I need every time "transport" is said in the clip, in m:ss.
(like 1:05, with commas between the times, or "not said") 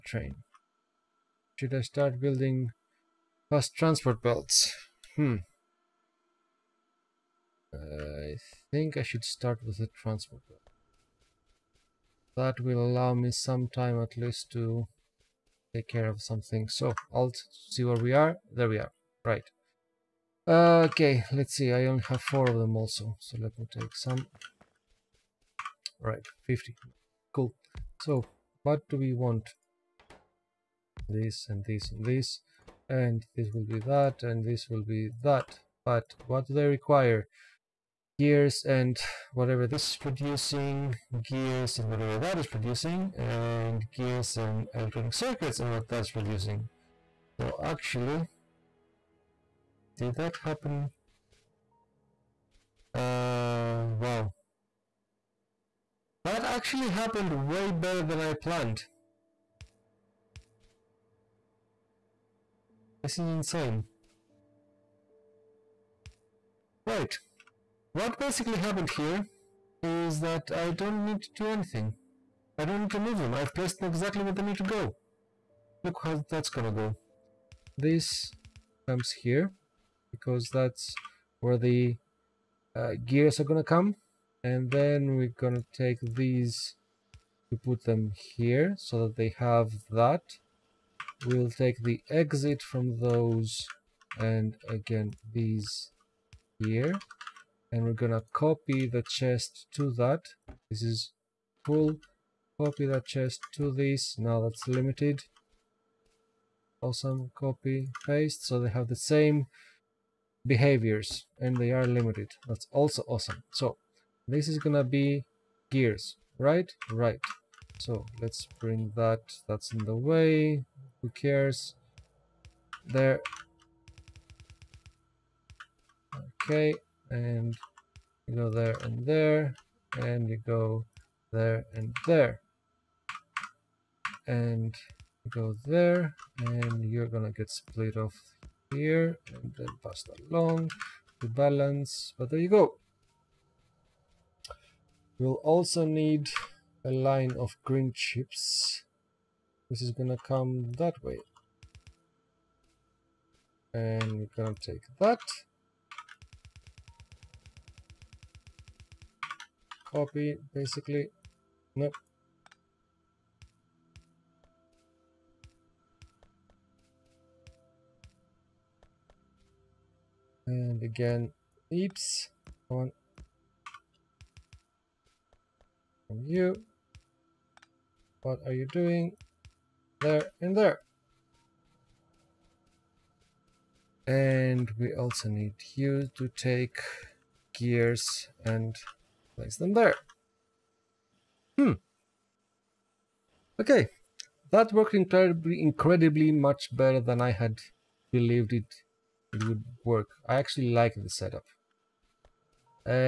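0:03, 0:10.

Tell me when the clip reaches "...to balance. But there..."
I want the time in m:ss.
2:21.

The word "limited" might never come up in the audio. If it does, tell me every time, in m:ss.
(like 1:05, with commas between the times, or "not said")
1:44, 1:51.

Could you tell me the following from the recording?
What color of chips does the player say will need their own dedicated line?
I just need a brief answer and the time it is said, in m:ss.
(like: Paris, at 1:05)
Green, at 2:27.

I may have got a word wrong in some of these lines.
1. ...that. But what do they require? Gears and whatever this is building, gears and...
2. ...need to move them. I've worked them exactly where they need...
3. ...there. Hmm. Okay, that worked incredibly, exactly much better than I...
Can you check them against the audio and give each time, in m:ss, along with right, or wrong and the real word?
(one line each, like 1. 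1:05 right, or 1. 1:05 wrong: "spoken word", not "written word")
1. 0:35 wrong: "producing", not "building"
2. 1:12 wrong: "placed", not "worked"
3. 3:09 wrong: "incredibly", not "exactly".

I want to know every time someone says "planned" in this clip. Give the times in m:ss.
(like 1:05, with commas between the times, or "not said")
0:58.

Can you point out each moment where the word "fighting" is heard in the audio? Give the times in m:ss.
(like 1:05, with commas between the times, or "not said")
not said.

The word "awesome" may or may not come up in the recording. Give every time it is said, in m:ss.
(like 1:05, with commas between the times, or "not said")
1:46, 1:53.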